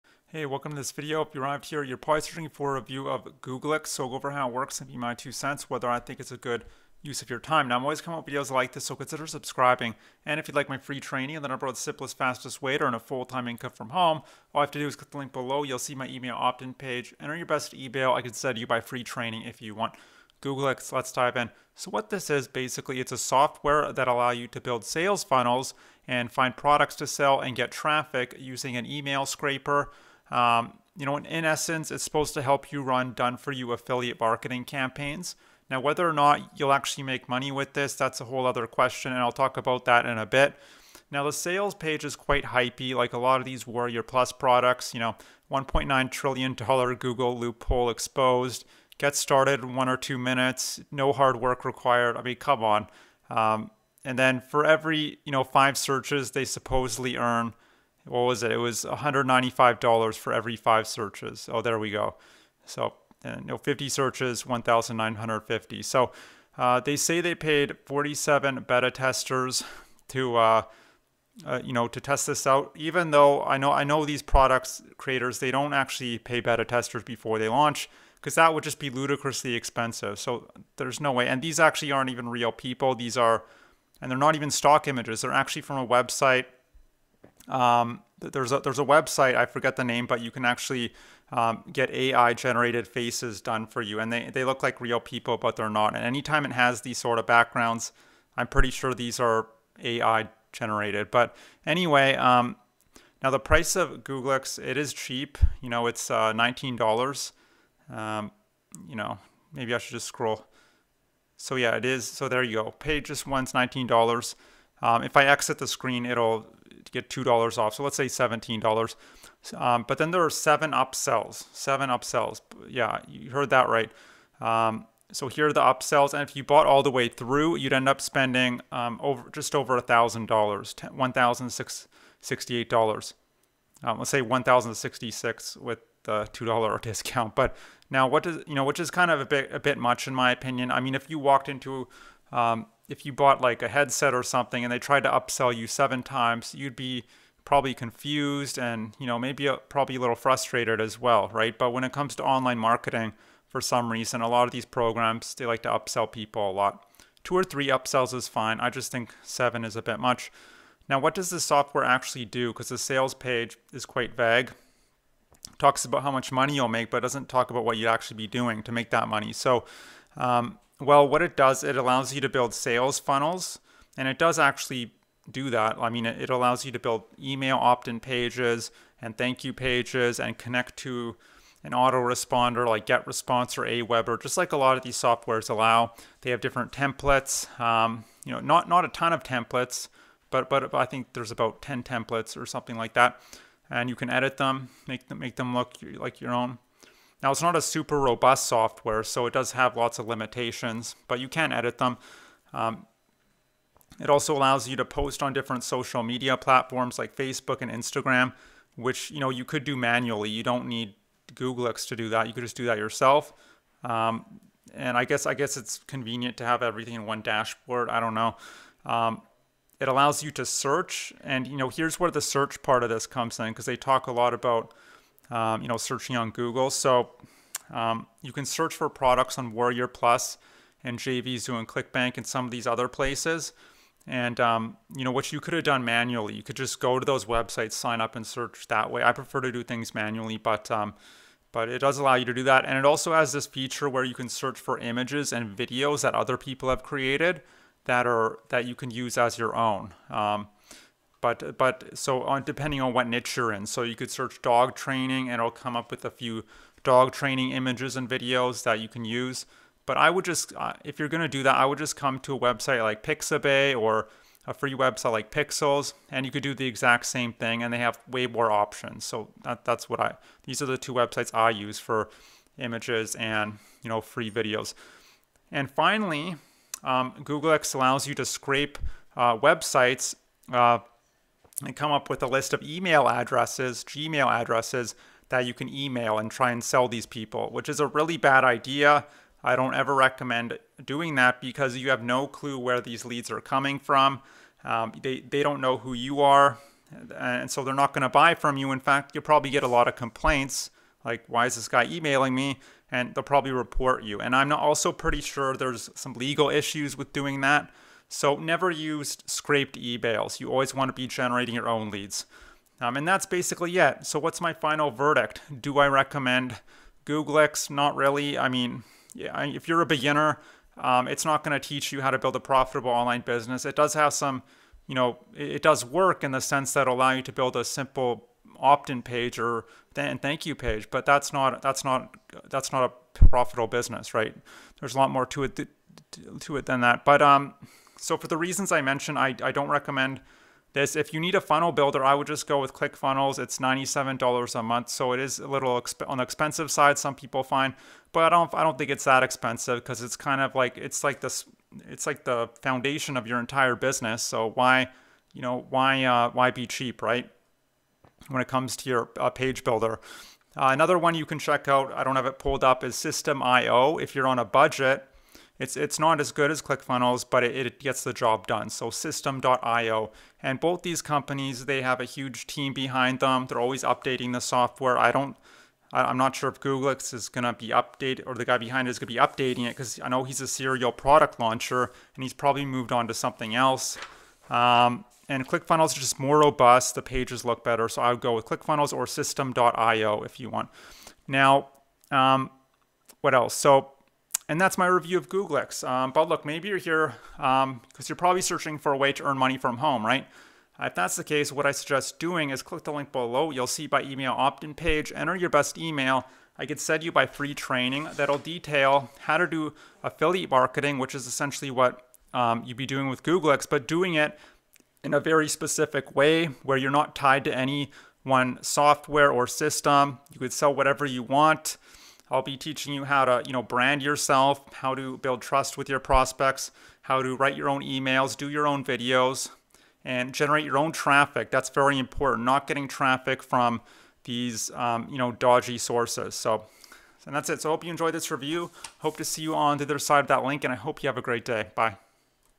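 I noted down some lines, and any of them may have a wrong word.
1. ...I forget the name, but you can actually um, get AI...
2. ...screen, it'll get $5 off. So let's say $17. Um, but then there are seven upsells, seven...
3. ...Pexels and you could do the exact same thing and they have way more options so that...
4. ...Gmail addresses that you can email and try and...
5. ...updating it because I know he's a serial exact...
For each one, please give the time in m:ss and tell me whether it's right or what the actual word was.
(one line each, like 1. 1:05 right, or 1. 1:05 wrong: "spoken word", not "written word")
1. 1:29 right
2. 1:55 wrong: "2", not "5"
3. 4:25 right
4. 4:43 right
5. 6:19 wrong: "product", not "exact".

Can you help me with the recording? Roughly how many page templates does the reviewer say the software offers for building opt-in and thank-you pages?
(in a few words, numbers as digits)
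10.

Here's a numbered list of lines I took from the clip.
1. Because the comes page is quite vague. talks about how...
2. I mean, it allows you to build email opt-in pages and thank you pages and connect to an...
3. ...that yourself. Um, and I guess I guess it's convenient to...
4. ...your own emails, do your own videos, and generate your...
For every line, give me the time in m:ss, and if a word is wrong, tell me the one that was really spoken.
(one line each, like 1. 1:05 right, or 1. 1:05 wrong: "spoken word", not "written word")
1. 2:42 wrong: "sales", not "comes"
2. 2:55 right
3. 3:32 right
4. 7:07 right.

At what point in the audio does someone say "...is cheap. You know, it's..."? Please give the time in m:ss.
1:44.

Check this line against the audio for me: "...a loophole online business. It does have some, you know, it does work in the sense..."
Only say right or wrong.
wrong.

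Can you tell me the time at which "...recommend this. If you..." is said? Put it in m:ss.
5:39.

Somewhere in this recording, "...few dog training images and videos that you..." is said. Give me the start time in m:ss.
4:16.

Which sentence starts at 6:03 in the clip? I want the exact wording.
If you're on a budget, it's, it's not as good as ClickFunnels, but it, it gets the job done.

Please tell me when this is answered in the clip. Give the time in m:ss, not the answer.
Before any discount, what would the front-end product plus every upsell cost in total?
2:10.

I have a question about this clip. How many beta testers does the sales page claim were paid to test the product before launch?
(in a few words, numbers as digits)
47.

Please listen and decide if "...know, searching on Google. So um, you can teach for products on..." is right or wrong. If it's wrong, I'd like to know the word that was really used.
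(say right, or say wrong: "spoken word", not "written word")
wrong: "search", not "teach".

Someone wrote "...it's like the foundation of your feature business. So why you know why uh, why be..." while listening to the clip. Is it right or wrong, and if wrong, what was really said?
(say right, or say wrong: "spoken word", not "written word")
wrong: "entire", not "feature".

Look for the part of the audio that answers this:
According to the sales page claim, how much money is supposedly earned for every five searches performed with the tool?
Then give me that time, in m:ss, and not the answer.
0:58.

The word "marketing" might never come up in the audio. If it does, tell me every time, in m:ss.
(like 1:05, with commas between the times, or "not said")
0:34, 2:32, 6:50.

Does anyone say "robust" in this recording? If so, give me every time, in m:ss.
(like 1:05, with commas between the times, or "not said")
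3:17, 6:26.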